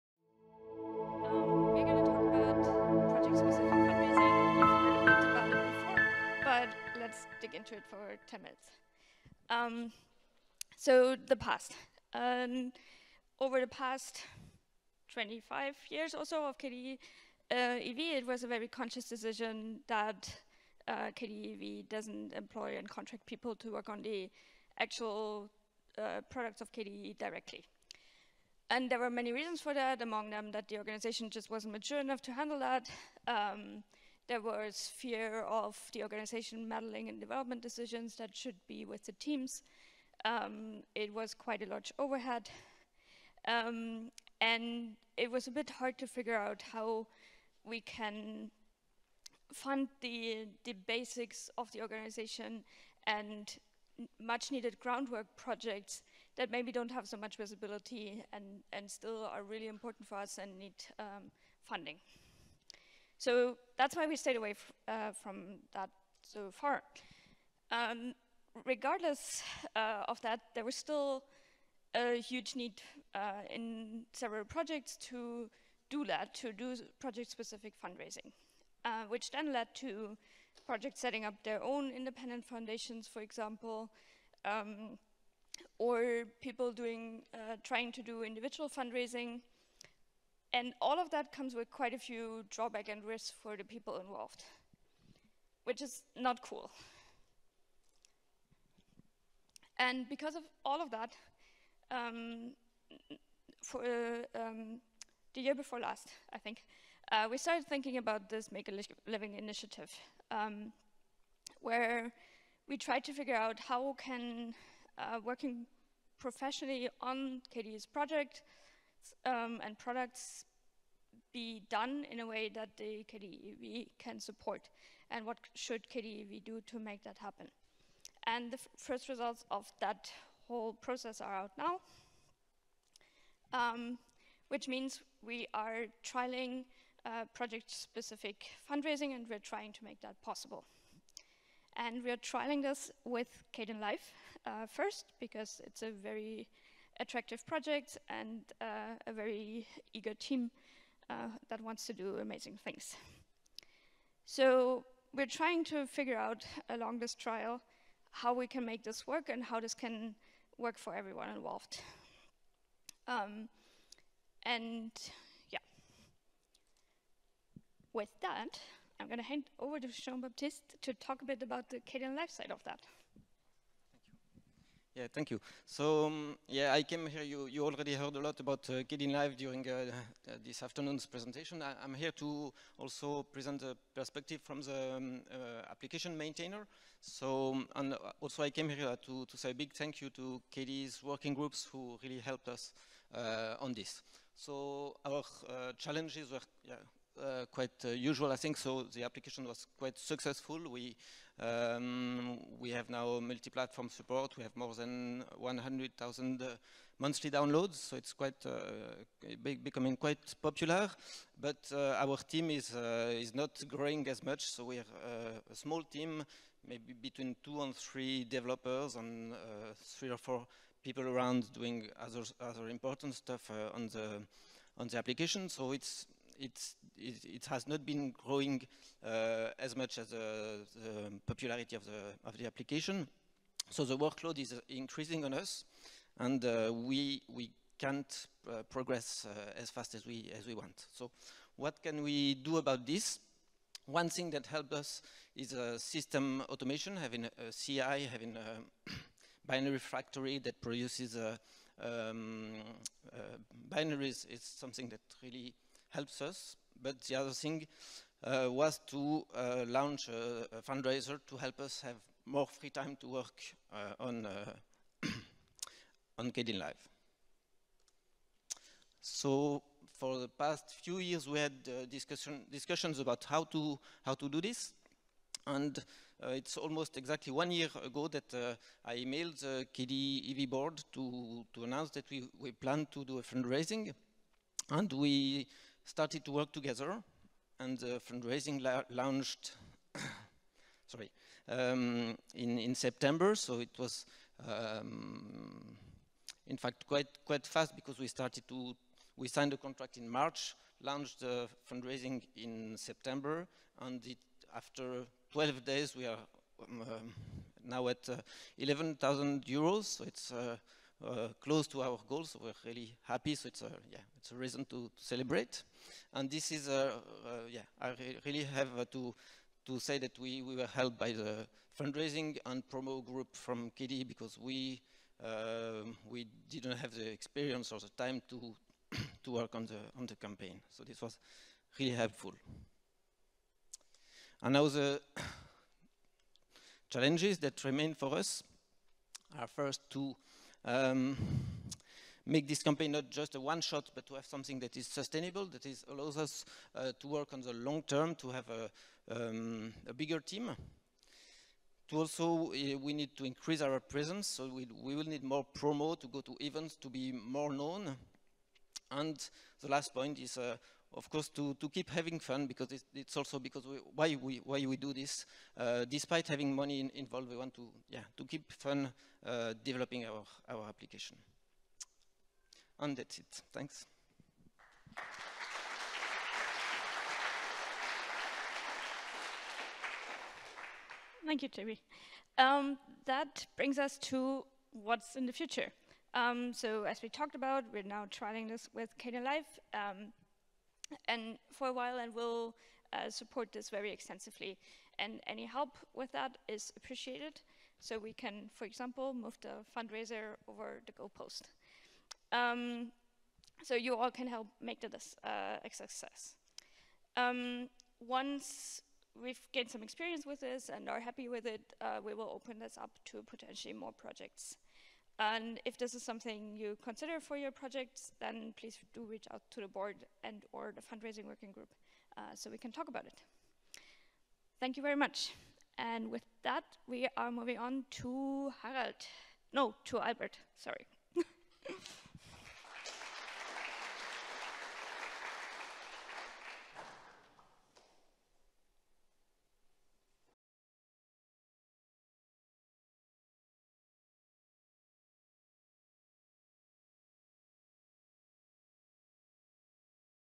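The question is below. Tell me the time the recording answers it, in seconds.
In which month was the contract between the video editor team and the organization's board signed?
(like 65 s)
300 s.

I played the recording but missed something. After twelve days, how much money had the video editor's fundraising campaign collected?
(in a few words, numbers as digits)
11,000 euros.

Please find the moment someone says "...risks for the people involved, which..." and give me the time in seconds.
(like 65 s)
93 s.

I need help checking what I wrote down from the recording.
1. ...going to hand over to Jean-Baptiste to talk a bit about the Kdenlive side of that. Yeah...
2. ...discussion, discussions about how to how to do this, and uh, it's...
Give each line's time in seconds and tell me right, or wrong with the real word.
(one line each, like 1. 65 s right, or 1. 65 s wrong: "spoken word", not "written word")
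1. 169 s right
2. 271 s right.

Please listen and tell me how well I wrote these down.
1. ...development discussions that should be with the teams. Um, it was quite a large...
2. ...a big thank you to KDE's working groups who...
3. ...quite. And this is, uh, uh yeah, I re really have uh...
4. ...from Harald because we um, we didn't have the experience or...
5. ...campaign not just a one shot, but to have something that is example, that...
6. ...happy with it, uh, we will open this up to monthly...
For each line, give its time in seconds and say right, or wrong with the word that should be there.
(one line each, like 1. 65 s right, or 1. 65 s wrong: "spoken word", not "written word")
1. 37 s wrong: "decisions", not "discussions"
2. 189 s right
3. 314 s wrong: "celebrate", not "quite"
4. 323 s wrong: "KDE", not "Harald"
5. 342 s wrong: "sustainable", not "example"
6. 410 s wrong: "potentially", not "monthly".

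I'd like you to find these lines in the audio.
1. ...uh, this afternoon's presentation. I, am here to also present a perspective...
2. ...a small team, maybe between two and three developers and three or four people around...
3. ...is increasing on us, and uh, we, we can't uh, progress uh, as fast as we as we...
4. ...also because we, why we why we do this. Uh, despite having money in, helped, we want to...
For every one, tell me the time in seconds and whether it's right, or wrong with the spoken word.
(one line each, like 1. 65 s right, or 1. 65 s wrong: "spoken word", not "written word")
1. 180 s right
2. 215 s right
3. 234 s right
4. 363 s wrong: "involved", not "helped".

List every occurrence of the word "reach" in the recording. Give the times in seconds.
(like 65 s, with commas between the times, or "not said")
419 s.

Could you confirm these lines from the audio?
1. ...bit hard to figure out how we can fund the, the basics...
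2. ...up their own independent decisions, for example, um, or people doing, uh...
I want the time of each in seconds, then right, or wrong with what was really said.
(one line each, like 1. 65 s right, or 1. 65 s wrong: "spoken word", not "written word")
1. 45 s right
2. 81 s wrong: "foundations", not "decisions".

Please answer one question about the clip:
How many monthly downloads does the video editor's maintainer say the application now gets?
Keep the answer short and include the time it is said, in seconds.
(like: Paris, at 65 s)
100,000, at 205 s.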